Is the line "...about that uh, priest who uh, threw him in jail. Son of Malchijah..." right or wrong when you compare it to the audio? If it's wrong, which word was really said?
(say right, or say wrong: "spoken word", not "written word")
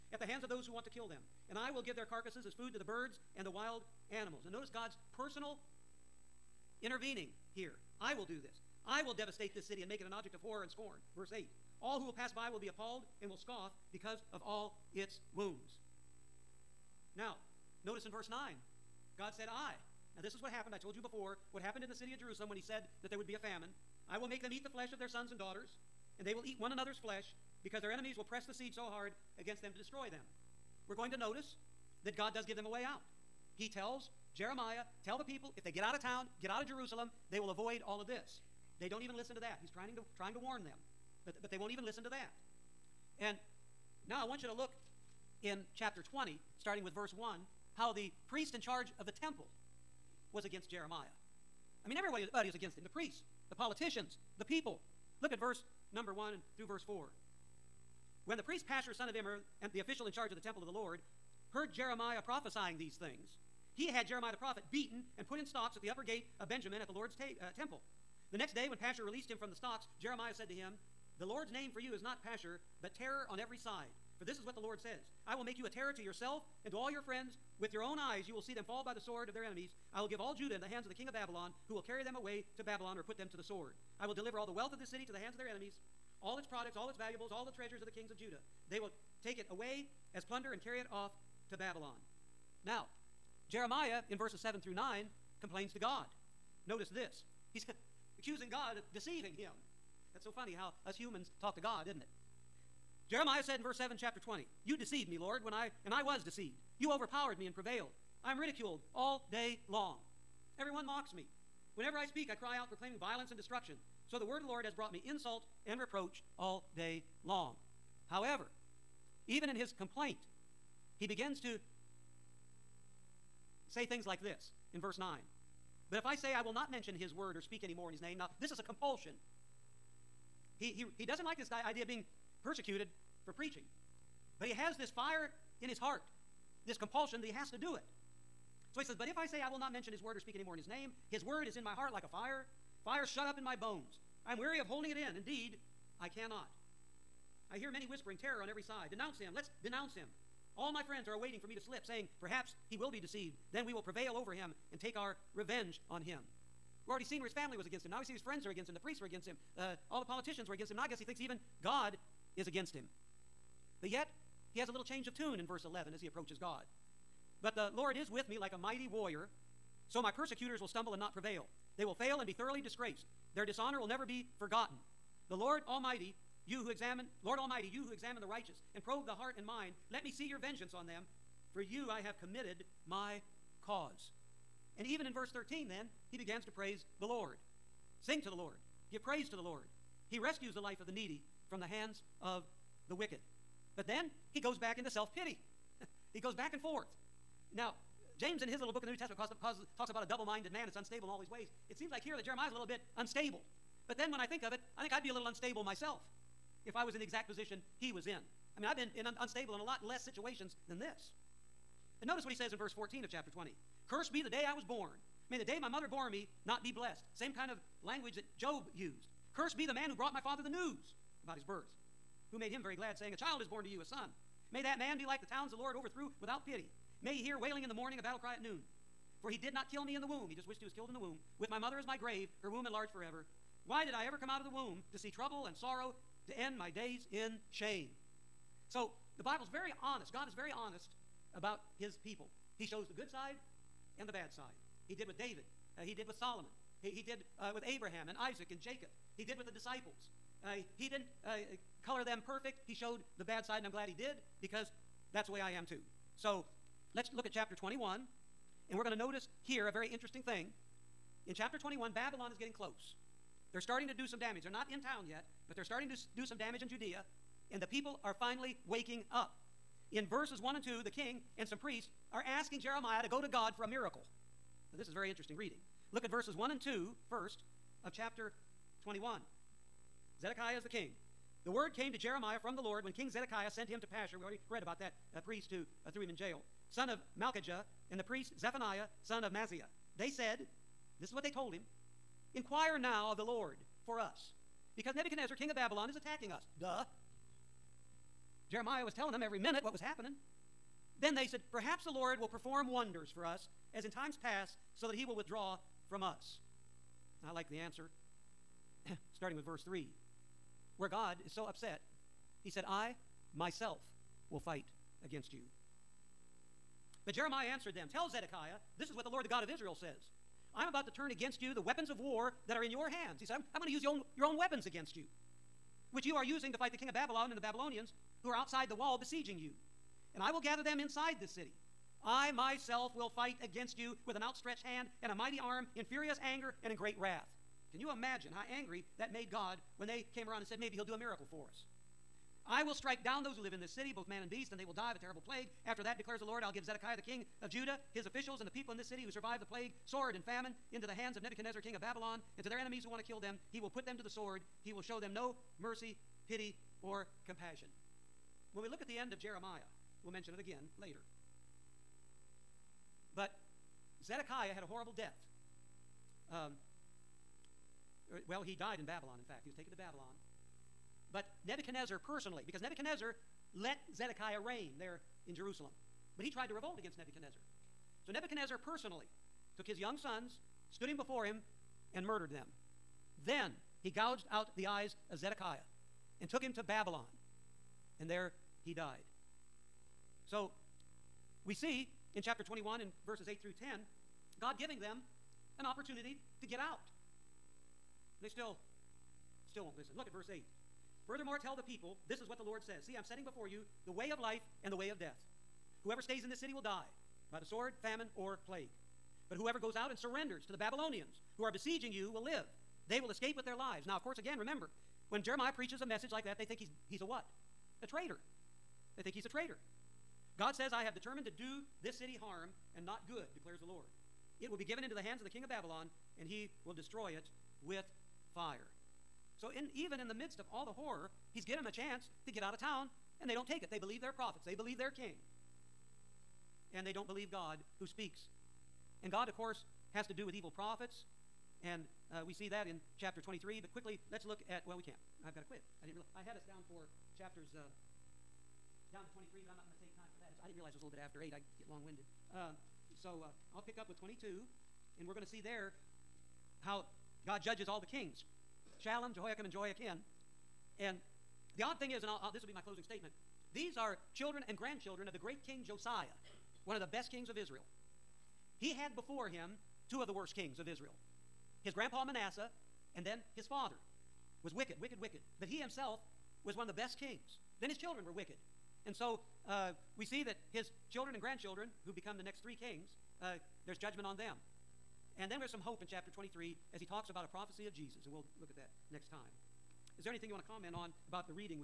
right.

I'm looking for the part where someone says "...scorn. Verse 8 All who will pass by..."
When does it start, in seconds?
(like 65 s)
10 s.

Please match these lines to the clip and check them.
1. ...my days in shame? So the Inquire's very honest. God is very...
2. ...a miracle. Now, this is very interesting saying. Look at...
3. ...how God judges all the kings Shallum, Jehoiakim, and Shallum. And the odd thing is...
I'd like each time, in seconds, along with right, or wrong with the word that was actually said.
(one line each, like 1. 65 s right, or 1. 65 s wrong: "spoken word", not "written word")
1. 236 s wrong: "Bible", not "Inquire"
2. 273 s wrong: "reading", not "saying"
3. 456 s wrong: "Jehoiachin", not "Shallum".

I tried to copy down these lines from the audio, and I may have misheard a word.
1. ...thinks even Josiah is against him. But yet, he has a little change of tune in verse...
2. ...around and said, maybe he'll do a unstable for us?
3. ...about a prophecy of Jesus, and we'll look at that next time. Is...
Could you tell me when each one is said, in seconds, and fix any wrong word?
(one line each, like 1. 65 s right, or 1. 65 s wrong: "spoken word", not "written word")
1. 161 s wrong: "God", not "Josiah"
2. 340 s wrong: "miracle", not "unstable"
3. 487 s right.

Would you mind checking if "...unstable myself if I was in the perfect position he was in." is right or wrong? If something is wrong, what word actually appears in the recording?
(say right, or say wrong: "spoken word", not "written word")
wrong: "exact", not "perfect".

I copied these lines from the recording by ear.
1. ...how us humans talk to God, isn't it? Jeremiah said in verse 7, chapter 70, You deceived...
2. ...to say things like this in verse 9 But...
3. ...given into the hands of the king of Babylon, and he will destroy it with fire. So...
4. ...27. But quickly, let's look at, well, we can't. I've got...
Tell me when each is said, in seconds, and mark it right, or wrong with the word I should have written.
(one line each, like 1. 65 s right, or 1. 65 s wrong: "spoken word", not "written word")
1. 100 s wrong: "20", not "70"
2. 121 s right
3. 424 s right
4. 443 s wrong: "23", not "27".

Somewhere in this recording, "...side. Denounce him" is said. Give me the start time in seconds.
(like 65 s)
148 s.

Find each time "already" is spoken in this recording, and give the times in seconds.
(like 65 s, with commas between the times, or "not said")
156 s, 284 s.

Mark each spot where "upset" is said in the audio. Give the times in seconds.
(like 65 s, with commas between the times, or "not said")
311 s.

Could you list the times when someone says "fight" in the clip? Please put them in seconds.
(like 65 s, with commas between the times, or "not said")
314 s, 326 s, 333 s.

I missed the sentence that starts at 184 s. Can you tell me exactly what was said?
And even in verse 13, then, he begins to praise the Lord.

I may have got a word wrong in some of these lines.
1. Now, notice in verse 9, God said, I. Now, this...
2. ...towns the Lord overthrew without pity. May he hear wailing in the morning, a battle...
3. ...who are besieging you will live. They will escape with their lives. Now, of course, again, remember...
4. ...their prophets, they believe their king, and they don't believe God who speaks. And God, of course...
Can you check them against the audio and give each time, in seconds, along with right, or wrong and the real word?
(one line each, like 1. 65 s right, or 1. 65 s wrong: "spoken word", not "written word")
1. 17 s right
2. 225 s right
3. 411 s right
4. 434 s right.